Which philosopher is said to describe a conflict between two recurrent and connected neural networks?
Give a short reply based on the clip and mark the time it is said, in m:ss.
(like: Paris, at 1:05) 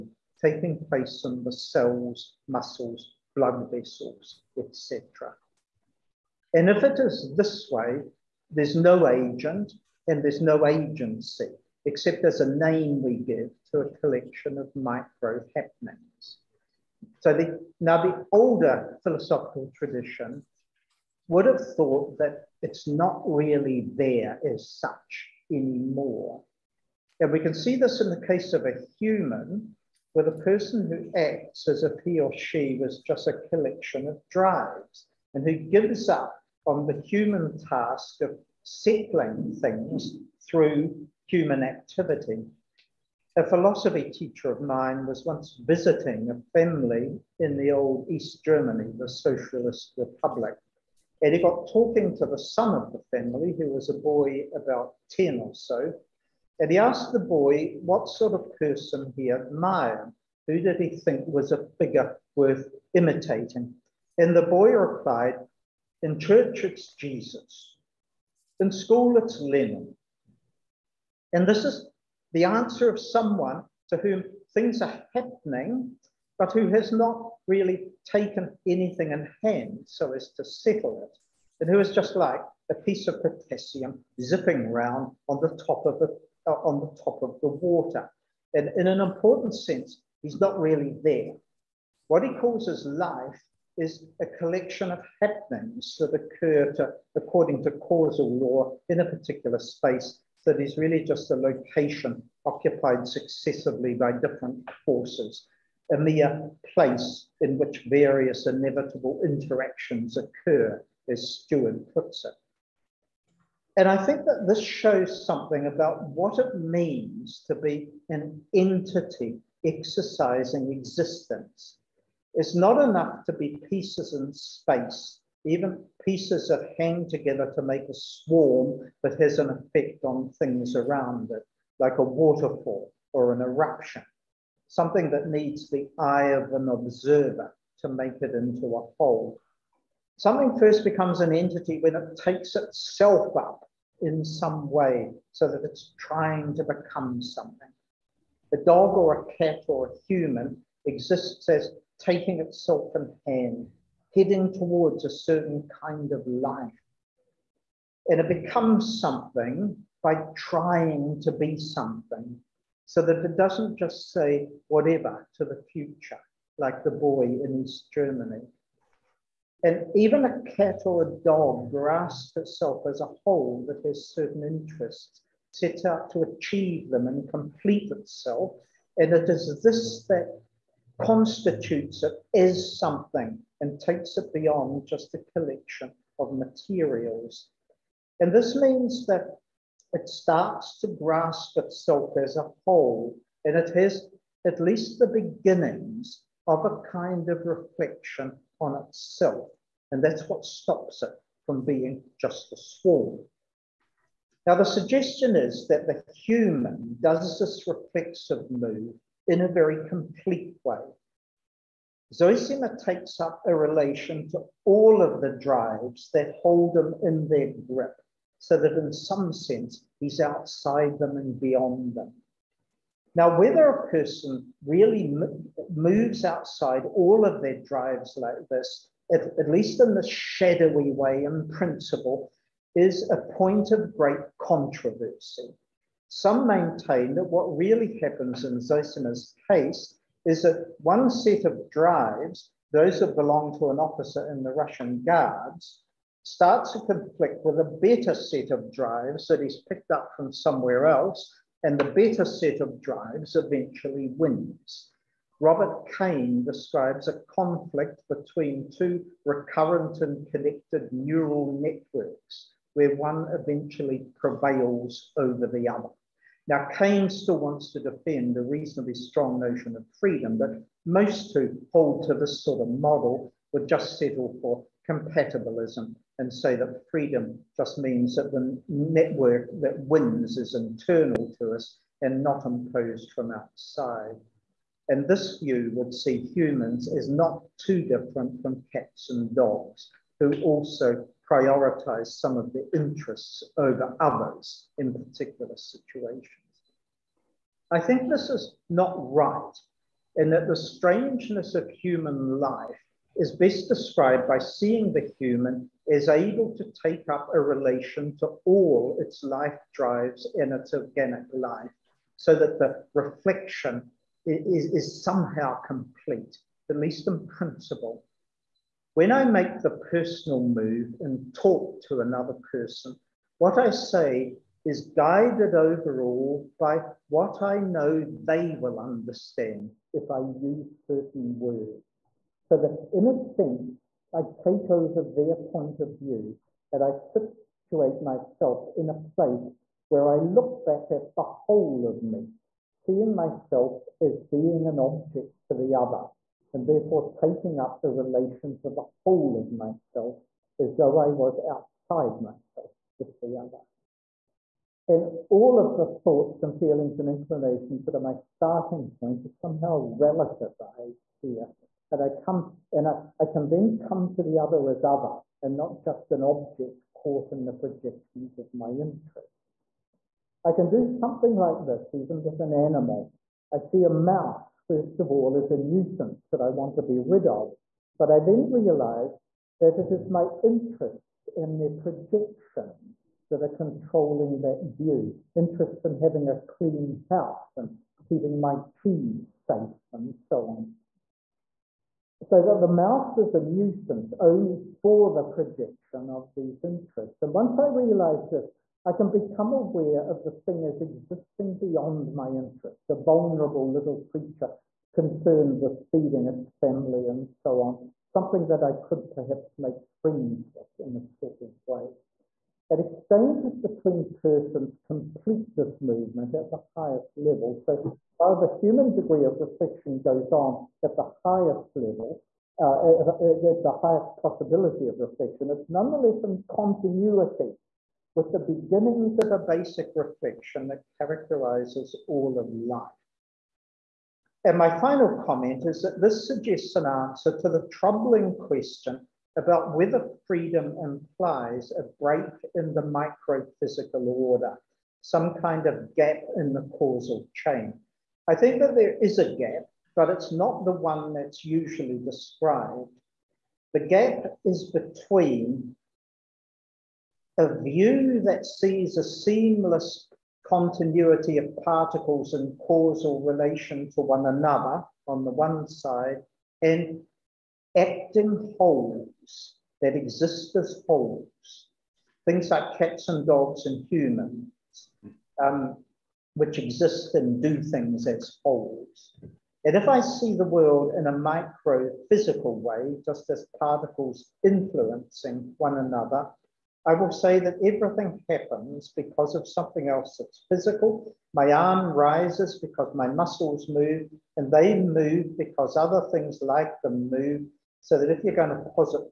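Robert Kane, at 4:15.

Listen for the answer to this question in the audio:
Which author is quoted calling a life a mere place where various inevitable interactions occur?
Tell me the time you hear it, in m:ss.
1:51.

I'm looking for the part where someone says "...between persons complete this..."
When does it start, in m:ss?
6:53.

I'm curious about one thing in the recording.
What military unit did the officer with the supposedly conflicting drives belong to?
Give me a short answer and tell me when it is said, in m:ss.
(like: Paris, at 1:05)
Russian Guards, at 4:04.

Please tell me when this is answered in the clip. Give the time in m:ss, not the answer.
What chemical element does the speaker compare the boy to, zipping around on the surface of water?
1:23.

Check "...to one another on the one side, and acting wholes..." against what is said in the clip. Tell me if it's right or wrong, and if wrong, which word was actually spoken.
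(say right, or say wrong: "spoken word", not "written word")
right.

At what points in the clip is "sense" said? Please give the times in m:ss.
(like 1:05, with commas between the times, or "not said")
1:29, 3:39, 5:33.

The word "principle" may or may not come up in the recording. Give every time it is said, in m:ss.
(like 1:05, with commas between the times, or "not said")
3:51, 5:17.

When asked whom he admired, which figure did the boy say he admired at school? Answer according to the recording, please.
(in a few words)
Lenin.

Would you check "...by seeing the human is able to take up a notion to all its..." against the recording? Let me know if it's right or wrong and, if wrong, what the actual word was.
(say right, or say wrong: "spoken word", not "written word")
wrong: "relation", not "notion".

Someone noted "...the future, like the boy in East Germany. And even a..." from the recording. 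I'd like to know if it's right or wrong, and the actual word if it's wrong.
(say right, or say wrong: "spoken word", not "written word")
right.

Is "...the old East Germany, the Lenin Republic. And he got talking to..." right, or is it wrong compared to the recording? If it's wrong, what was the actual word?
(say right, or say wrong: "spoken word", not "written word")
wrong: "Socialist", not "Lenin".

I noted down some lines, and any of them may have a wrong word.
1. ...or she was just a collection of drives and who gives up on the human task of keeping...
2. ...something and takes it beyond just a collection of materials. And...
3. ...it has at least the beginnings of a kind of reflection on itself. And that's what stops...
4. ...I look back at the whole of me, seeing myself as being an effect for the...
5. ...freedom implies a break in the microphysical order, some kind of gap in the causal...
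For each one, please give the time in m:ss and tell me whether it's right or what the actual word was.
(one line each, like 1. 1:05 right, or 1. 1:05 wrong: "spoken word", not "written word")
1. 0:32 wrong: "settling", not "keeping"
2. 3:02 right
3. 3:13 right
4. 5:40 wrong: "object", not "effect"
5. 7:20 right.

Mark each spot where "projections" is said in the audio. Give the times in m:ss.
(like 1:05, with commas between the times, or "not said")
6:07, 6:21, 6:35.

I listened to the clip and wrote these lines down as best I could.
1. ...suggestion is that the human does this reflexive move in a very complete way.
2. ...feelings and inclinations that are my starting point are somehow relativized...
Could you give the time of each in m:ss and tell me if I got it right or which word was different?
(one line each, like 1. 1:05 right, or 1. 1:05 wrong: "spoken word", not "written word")
1. 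3:24 right
2. 5:56 right.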